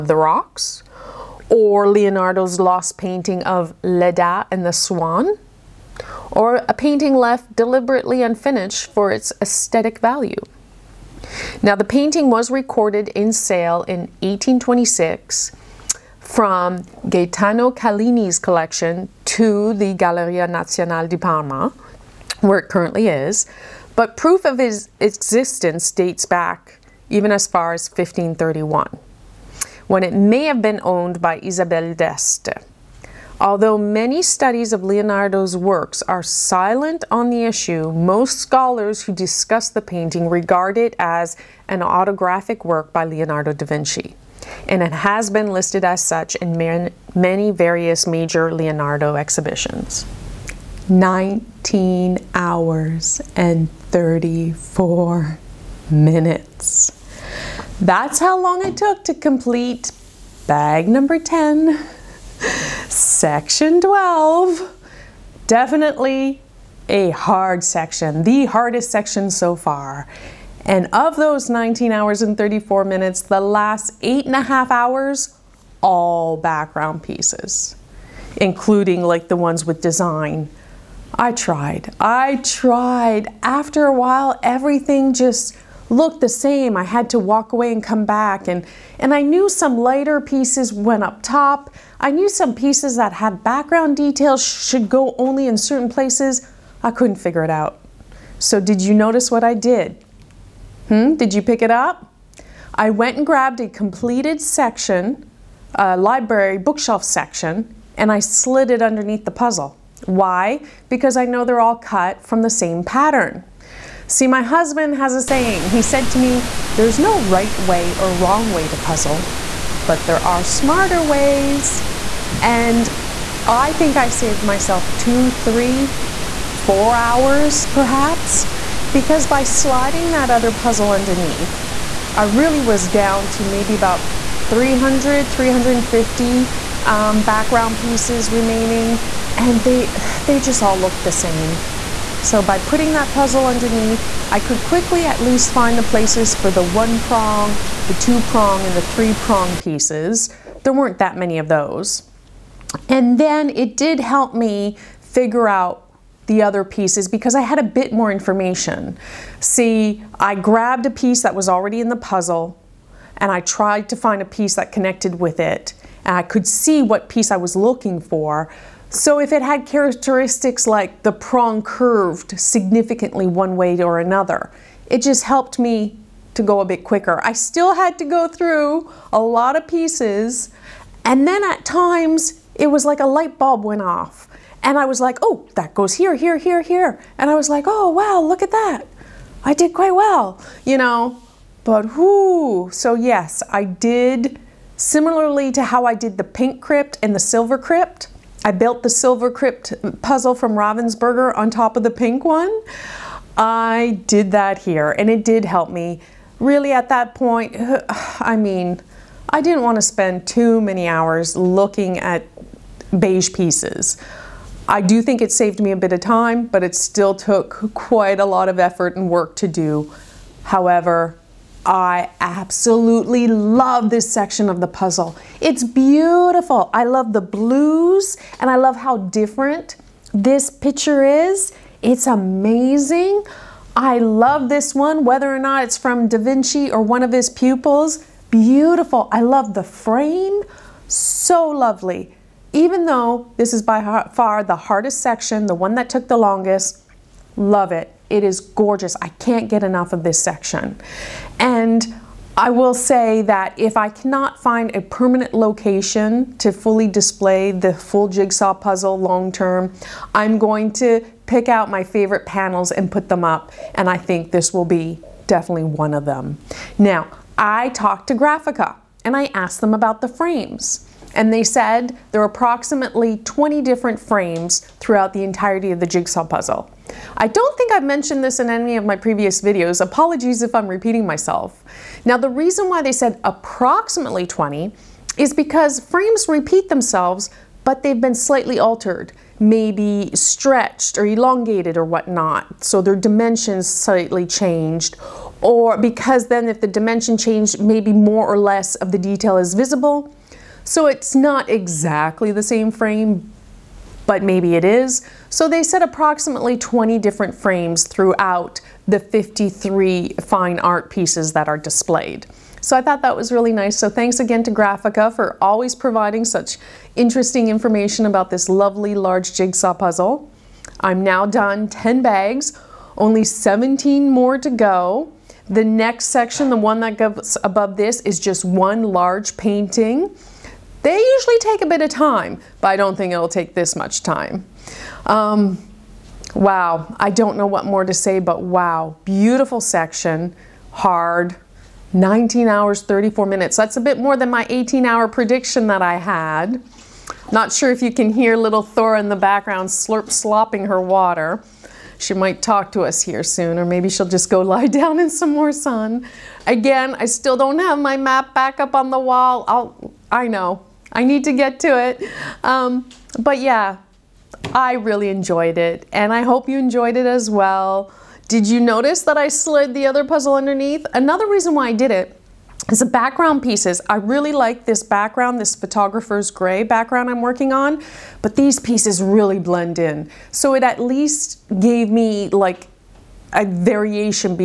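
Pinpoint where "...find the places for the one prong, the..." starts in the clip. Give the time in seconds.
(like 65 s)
145 s.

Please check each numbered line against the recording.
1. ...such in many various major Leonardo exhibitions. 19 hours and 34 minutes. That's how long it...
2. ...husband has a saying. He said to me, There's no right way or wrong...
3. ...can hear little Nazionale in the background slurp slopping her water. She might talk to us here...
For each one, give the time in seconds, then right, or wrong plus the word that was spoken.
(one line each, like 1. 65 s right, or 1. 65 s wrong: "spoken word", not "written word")
1. 46 s right
2. 114 s right
3. 347 s wrong: "Thor", not "Nazionale".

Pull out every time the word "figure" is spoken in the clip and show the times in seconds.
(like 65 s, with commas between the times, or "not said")
97 s, 154 s.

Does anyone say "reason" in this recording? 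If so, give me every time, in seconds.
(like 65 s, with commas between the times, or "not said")
282 s, 371 s.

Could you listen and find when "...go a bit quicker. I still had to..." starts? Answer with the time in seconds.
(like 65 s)
176 s.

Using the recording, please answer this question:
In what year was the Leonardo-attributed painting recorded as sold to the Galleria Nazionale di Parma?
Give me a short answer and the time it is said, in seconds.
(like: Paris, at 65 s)
1826, at 14 s.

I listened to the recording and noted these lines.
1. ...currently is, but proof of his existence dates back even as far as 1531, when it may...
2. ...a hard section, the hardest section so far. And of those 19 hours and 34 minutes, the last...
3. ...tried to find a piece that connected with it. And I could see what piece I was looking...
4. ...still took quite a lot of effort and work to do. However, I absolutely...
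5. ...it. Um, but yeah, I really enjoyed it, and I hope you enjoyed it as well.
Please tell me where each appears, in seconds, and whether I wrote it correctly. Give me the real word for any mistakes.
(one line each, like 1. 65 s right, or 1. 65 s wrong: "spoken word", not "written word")
1. 22 s right
2. 66 s right
3. 163 s right
4. 216 s right
5. 361 s right.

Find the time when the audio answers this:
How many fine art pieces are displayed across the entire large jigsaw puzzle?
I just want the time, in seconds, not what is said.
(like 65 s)
308 s.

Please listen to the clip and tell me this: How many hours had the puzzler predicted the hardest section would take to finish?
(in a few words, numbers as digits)
18 hours.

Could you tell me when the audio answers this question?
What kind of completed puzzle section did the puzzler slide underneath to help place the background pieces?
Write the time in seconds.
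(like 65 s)
105 s.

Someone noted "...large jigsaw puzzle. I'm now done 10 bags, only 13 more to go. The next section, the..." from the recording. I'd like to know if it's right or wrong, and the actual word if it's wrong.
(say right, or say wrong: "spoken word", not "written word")
wrong: "17", not "13".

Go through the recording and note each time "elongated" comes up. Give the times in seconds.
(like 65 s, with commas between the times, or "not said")
291 s.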